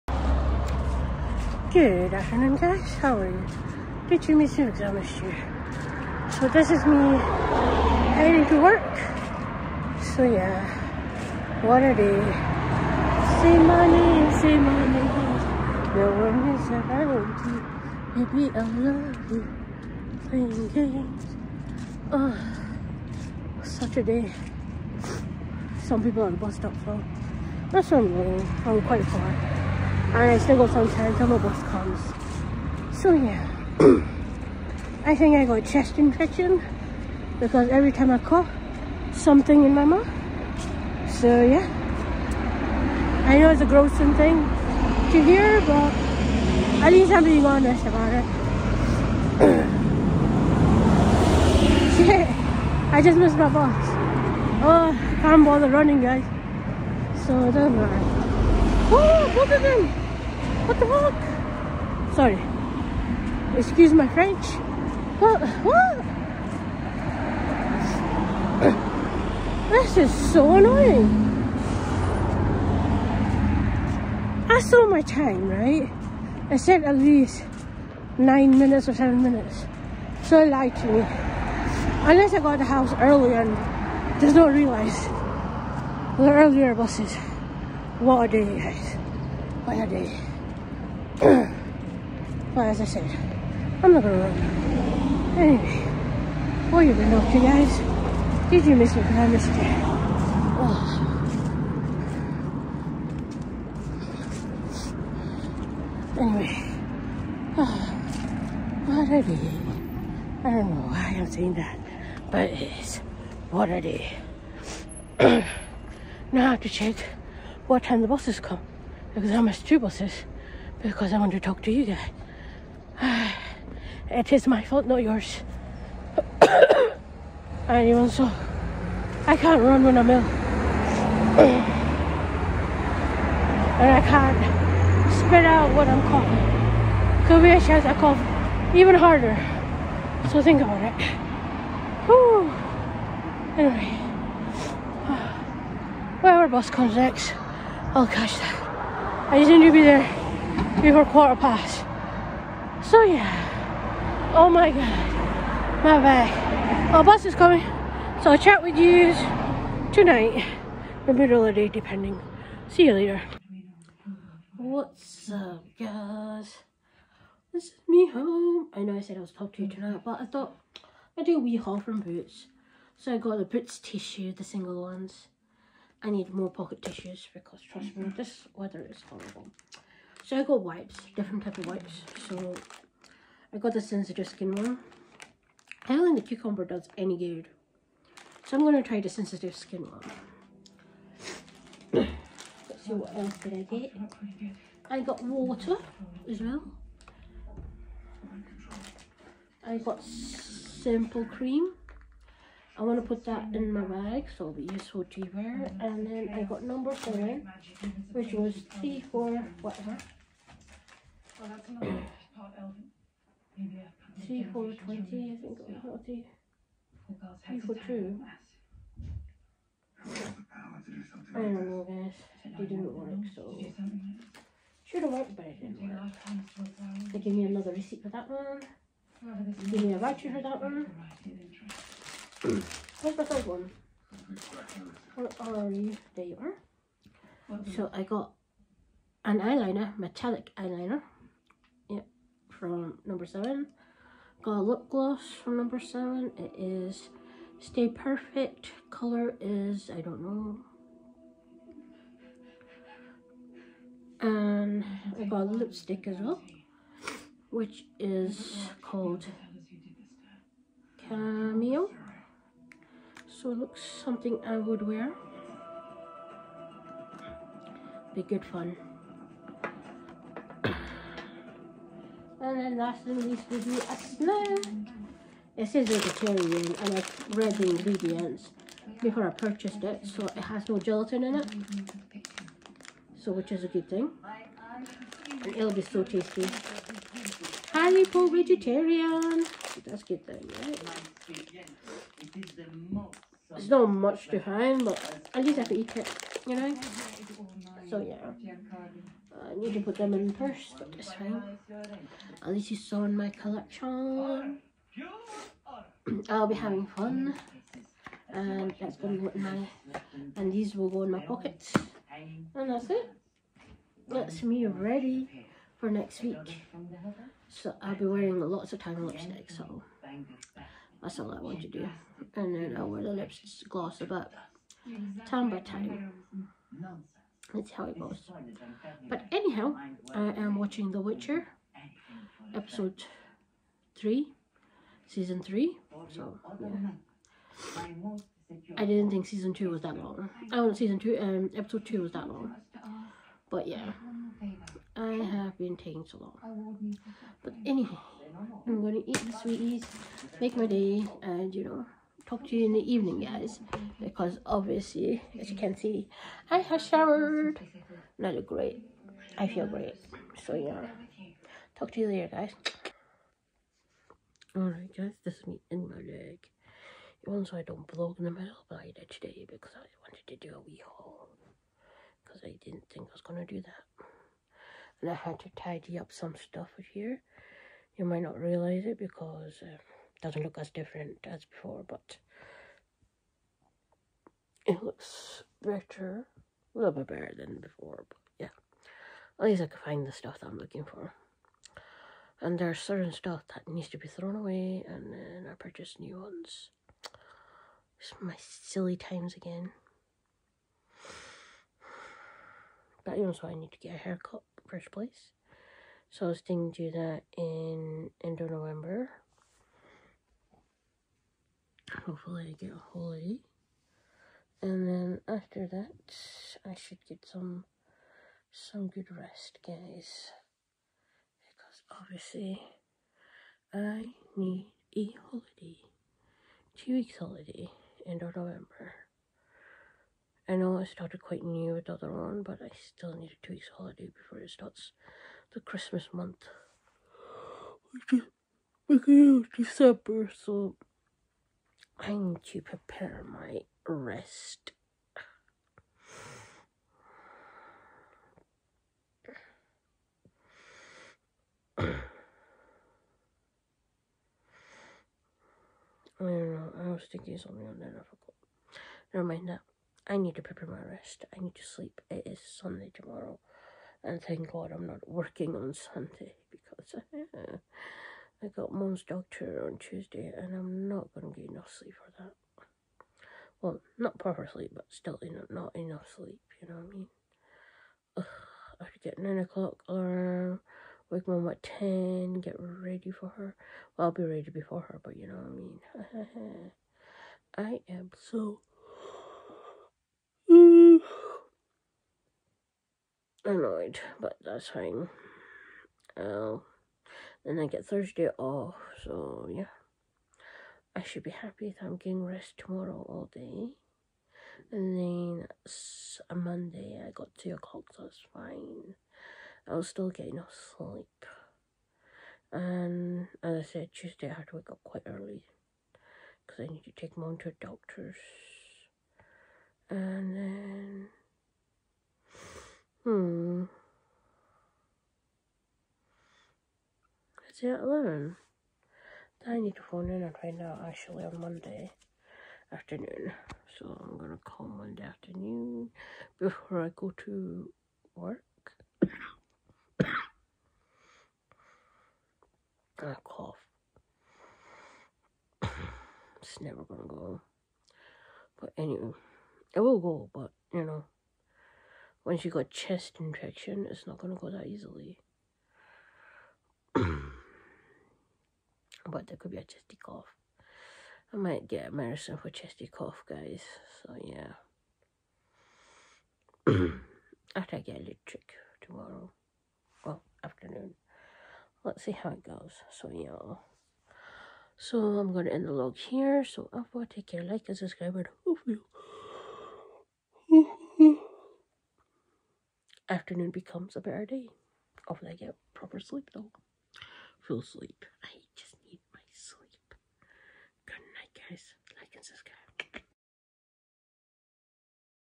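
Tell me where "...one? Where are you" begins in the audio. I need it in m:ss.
3:53.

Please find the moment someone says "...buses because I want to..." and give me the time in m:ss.
1:59.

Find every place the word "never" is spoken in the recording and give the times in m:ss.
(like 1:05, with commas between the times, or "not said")
7:39, 9:06.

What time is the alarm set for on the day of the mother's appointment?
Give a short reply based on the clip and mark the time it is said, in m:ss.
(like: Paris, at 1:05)
9 o'clock, at 7:59.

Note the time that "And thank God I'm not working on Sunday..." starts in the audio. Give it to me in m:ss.
7:44.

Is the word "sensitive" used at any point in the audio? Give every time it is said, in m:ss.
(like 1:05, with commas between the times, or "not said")
3:03, 3:09.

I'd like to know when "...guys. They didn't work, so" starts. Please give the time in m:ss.
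3:41.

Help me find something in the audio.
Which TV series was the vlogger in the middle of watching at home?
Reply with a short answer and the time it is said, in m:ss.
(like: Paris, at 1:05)
The Witcher, at 5:30.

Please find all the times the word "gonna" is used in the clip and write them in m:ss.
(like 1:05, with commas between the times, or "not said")
1:34, 3:08, 5:08, 8:54, 9:06, 9:14, 9:35.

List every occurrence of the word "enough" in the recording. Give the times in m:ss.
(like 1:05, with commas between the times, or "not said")
7:51, 7:55, 8:30.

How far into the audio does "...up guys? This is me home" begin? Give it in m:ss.
2:45.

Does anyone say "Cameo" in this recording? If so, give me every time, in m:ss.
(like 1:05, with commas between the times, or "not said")
4:21.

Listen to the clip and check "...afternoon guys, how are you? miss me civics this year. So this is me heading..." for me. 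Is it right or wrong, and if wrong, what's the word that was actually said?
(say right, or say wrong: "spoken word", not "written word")
right.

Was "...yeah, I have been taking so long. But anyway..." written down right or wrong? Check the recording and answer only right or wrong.
right.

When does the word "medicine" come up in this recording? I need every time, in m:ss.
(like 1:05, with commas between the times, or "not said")
9:21.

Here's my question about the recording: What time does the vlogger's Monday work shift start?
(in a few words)
2 o'clock.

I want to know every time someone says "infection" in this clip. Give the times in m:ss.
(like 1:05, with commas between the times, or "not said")
0:35, 9:13.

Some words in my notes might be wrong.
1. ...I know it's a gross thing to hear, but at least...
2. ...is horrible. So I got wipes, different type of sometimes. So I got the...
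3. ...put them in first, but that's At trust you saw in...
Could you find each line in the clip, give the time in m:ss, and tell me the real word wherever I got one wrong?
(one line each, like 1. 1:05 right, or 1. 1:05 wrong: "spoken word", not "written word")
1. 0:43 right
2. 2:58 wrong: "wipes", not "sometimes"
3. 4:59 wrong: "least", not "trust".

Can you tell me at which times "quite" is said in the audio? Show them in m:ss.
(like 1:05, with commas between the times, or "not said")
0:28, 7:11, 8:34.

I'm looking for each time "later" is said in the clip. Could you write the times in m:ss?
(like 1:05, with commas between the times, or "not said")
2:42, 6:02.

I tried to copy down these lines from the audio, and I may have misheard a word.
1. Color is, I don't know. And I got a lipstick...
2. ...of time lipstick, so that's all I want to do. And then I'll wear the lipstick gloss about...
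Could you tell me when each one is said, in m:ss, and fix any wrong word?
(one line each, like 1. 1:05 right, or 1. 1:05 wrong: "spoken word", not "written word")
1. 4:08 right
2. 5:18 right.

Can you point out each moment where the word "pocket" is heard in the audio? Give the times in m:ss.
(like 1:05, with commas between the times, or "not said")
2:56, 5:11.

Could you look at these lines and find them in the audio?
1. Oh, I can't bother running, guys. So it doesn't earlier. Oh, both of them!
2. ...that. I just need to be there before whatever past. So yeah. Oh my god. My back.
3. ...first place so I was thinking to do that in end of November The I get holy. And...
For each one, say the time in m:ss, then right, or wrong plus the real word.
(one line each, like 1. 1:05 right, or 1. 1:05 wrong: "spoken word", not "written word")
1. 0:54 wrong: "matter", not "earlier"
2. 2:28 wrong: "quarter", not "whatever"
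3. 6:44 wrong: "Hopefully", not "The".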